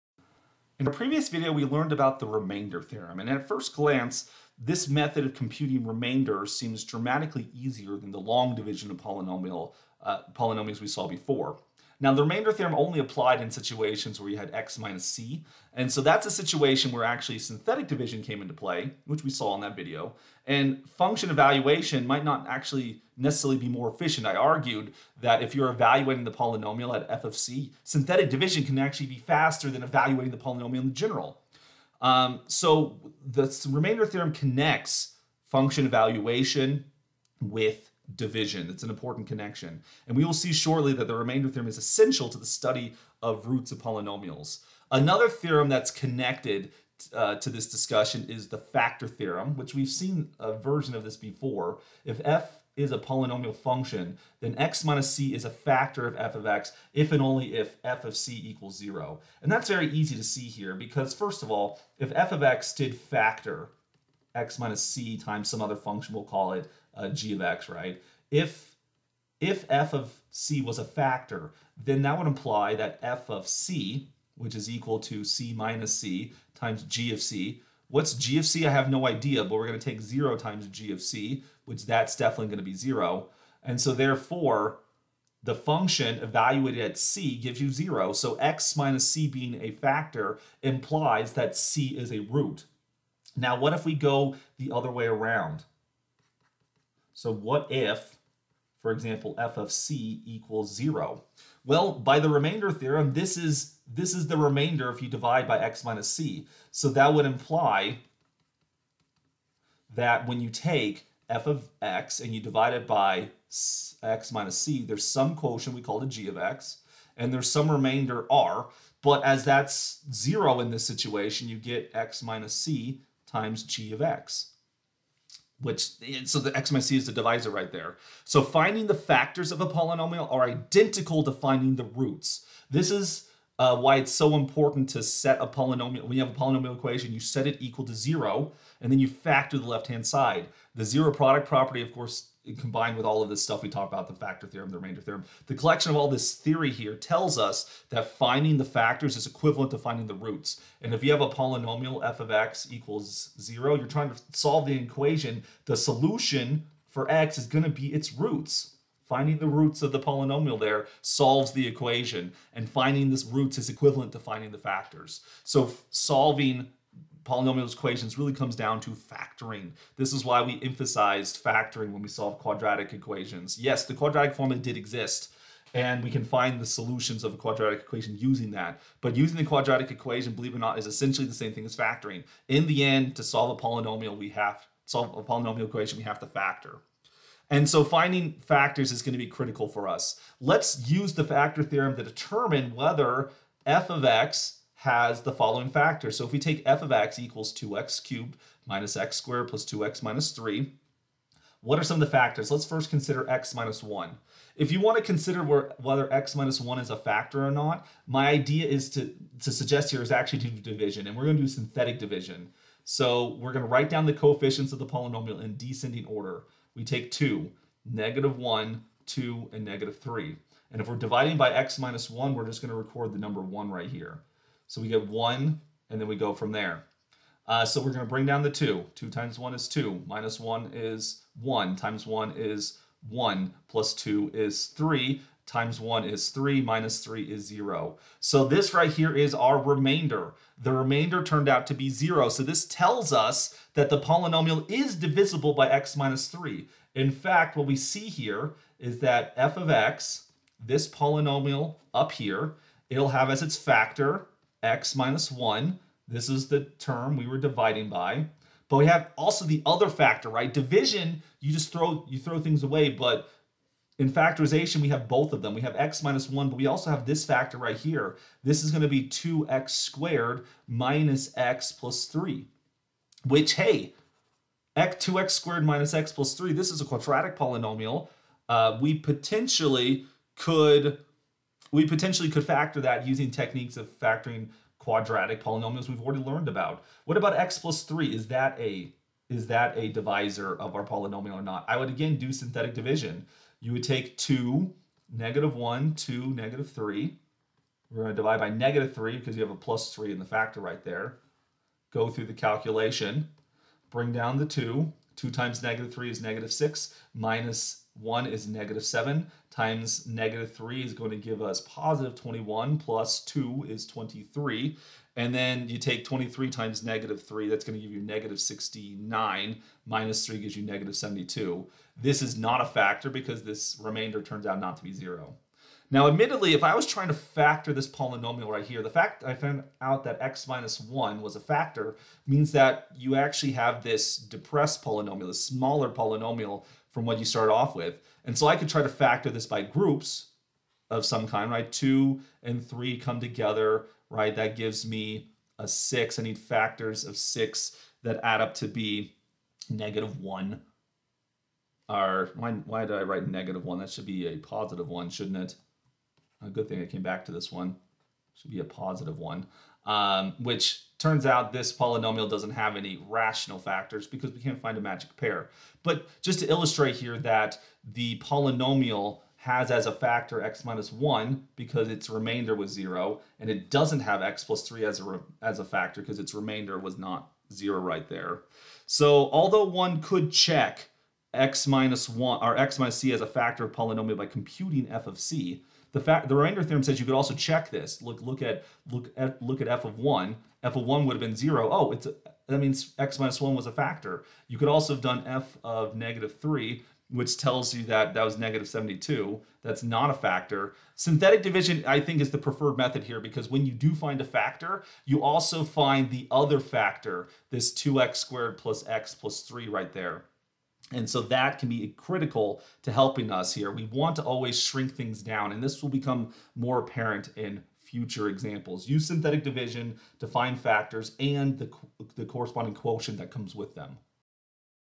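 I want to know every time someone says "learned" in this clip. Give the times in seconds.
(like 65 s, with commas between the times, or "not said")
1 s, 286 s.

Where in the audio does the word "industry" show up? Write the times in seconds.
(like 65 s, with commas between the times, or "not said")
not said.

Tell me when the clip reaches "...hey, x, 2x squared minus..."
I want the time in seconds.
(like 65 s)
273 s.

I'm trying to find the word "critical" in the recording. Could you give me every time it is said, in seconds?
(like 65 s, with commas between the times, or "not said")
189 s, 411 s.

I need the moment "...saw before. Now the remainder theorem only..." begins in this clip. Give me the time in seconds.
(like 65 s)
10 s.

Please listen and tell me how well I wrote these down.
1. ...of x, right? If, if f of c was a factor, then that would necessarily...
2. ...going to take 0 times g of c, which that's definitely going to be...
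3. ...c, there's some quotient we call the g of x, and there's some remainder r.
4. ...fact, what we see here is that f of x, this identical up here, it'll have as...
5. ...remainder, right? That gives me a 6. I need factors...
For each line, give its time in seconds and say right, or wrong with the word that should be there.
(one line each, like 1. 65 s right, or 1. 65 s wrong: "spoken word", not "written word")
1. 67 s wrong: "imply", not "necessarily"
2. 79 s right
3. 114 s right
4. 247 s wrong: "polynomial", not "identical"
5. 343 s wrong: "together", not "remainder".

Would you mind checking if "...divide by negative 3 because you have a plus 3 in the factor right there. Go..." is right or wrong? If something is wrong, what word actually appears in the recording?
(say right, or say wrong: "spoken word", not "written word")
right.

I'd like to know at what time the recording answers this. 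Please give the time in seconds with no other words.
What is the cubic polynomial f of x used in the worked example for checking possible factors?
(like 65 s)
197 s.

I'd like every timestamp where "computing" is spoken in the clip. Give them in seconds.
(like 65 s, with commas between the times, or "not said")
5 s, 384 s.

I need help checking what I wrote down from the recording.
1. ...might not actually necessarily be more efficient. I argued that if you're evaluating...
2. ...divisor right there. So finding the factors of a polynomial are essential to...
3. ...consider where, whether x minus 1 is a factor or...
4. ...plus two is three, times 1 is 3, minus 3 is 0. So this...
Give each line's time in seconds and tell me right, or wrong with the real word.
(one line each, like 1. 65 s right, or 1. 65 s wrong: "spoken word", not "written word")
1. 22 s right
2. 127 s wrong: "identical", not "essential"
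3. 205 s right
4. 233 s right.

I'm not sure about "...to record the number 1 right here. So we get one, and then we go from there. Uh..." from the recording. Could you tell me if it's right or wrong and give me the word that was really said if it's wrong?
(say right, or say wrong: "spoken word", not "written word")
right.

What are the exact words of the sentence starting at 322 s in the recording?
This is not a factor because this remainder turns out not to be 0.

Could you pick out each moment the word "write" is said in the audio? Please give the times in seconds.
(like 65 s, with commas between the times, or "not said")
213 s, 353 s.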